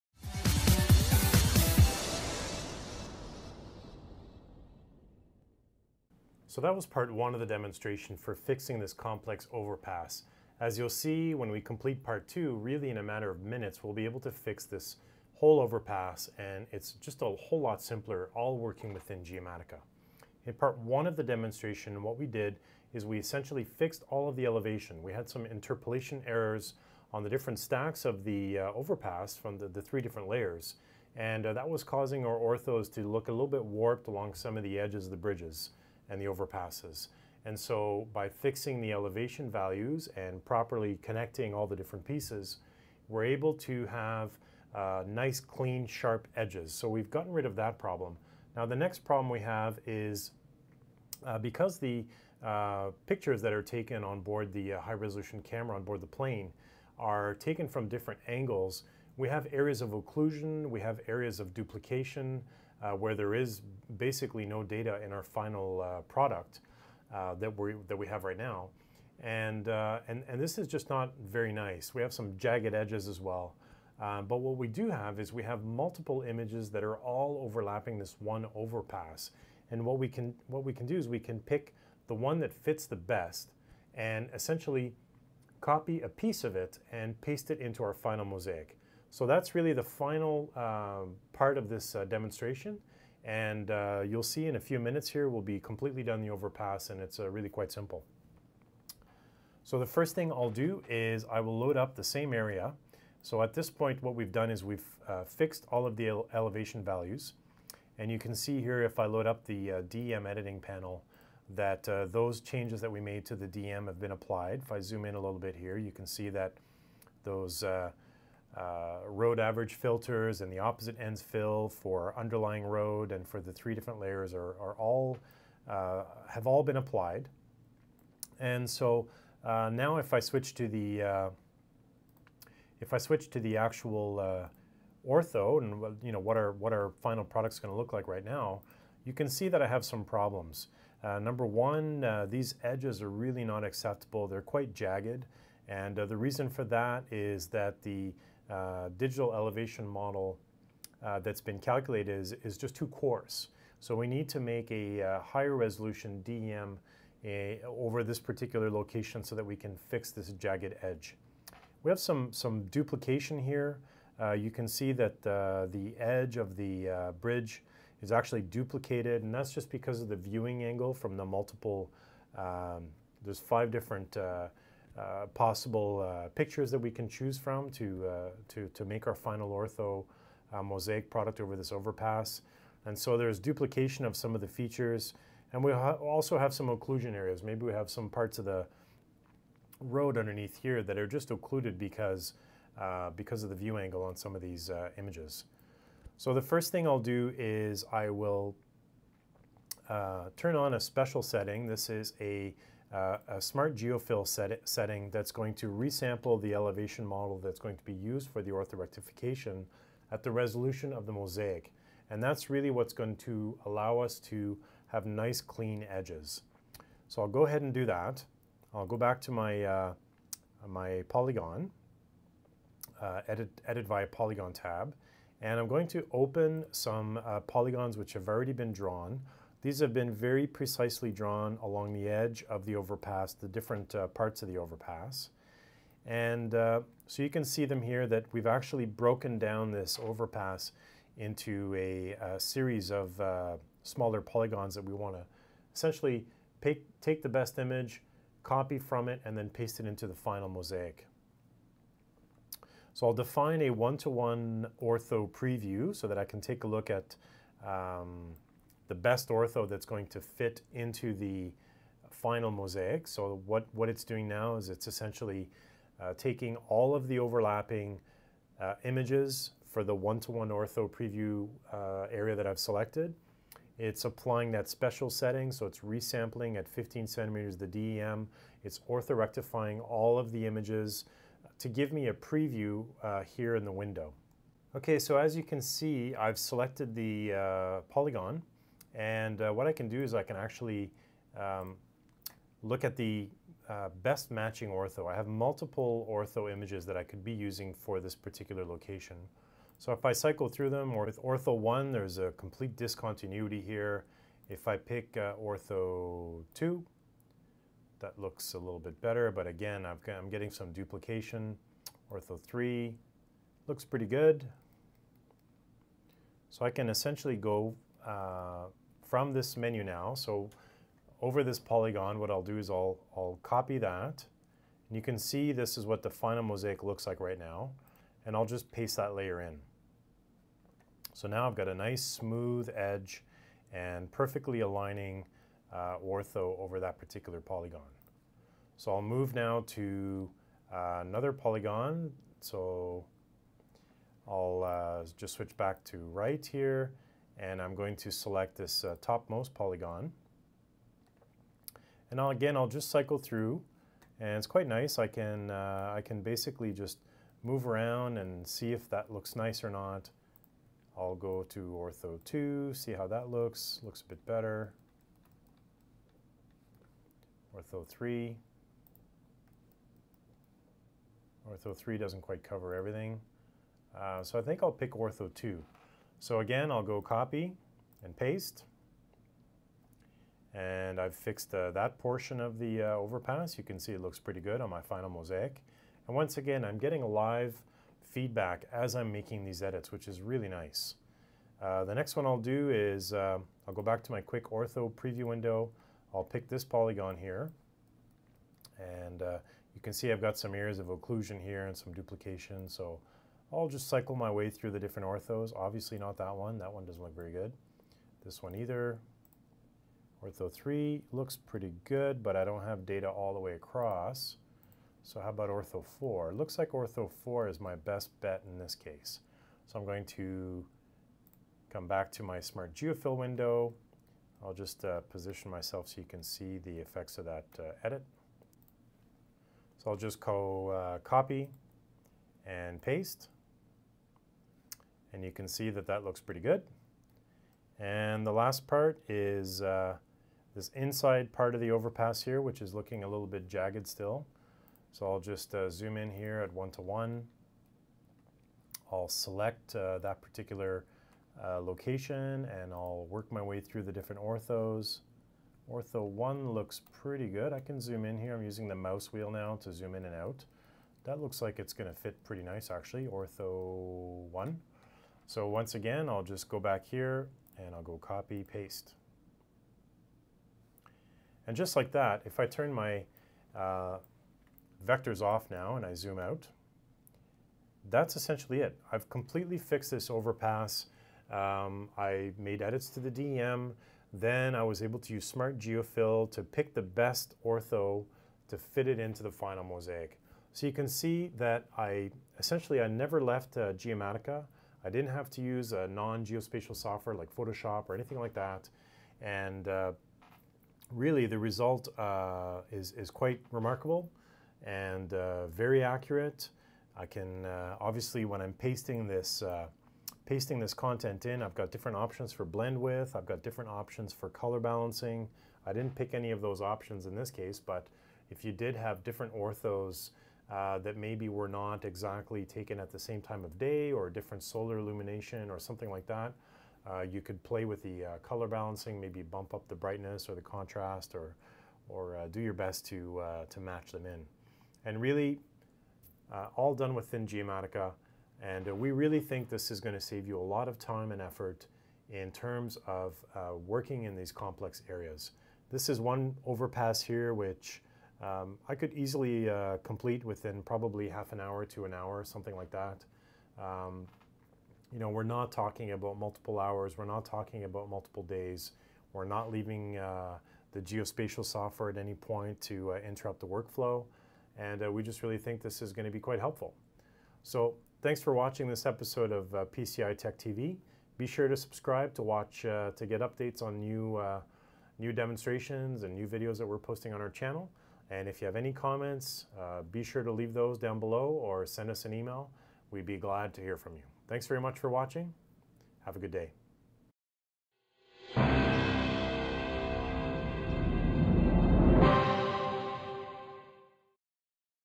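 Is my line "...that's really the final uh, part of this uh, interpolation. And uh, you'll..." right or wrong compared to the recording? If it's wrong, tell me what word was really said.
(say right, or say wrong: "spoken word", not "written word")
wrong: "demonstration", not "interpolation".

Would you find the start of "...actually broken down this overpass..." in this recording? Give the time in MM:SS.
03:58.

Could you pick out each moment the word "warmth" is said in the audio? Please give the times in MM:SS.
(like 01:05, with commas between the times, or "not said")
not said.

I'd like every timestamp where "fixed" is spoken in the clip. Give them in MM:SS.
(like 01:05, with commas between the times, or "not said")
00:23, 01:45, 06:21, 07:59.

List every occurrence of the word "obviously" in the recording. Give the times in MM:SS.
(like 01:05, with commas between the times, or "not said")
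06:45, 08:27.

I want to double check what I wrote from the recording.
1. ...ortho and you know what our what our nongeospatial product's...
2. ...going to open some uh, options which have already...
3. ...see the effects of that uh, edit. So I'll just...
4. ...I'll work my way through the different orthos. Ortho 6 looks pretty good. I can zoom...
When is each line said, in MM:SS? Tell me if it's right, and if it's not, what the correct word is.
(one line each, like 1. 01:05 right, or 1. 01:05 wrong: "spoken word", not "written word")
1. 02:15 wrong: "final", not "nongeospatial"
2. 03:45 wrong: "polygons", not "options"
3. 07:06 right
4. 07:32 wrong: "1", not "6".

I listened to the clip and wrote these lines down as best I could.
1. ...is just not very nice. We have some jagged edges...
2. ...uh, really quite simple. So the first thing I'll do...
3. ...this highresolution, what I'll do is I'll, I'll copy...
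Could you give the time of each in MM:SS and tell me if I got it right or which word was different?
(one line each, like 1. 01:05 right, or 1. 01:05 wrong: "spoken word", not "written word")
1. 01:10 right
2. 01:37 right
3. 05:21 wrong: "polygon", not "highresolution".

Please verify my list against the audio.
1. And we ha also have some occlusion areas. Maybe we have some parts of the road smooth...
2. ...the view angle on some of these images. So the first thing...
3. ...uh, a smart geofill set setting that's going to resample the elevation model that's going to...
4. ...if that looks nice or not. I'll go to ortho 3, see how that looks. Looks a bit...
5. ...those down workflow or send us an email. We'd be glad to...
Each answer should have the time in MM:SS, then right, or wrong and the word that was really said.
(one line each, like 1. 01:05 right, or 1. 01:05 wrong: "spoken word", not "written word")
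1. 03:05 wrong: "underneath", not "smooth"
2. 03:13 right
3. 03:22 right
4. 05:58 wrong: "2", not "3"
5. 09:40 wrong: "below", not "workflow".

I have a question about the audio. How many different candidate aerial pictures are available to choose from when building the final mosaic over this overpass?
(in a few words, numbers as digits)
5.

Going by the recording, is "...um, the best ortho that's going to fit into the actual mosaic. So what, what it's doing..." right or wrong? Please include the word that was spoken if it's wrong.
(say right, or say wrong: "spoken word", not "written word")
wrong: "final", not "actual".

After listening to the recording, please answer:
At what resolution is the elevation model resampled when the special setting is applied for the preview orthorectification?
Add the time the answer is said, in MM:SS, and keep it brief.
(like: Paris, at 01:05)
15 centimeters, at 04:36.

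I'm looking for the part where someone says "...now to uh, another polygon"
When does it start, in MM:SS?
05:39.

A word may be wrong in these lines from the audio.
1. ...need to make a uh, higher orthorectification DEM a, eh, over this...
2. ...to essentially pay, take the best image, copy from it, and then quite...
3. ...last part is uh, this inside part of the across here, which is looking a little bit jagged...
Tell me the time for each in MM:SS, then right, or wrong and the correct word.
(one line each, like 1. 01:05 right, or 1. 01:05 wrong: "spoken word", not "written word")
1. 02:34 wrong: "resolution", not "orthorectification"
2. 04:05 wrong: "paste", not "quite"
3. 07:18 wrong: "overpass", not "across".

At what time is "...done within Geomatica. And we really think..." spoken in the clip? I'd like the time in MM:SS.
08:56.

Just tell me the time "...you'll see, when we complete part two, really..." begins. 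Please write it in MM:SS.
00:10.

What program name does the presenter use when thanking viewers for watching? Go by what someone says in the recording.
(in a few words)
PCI Tech TV.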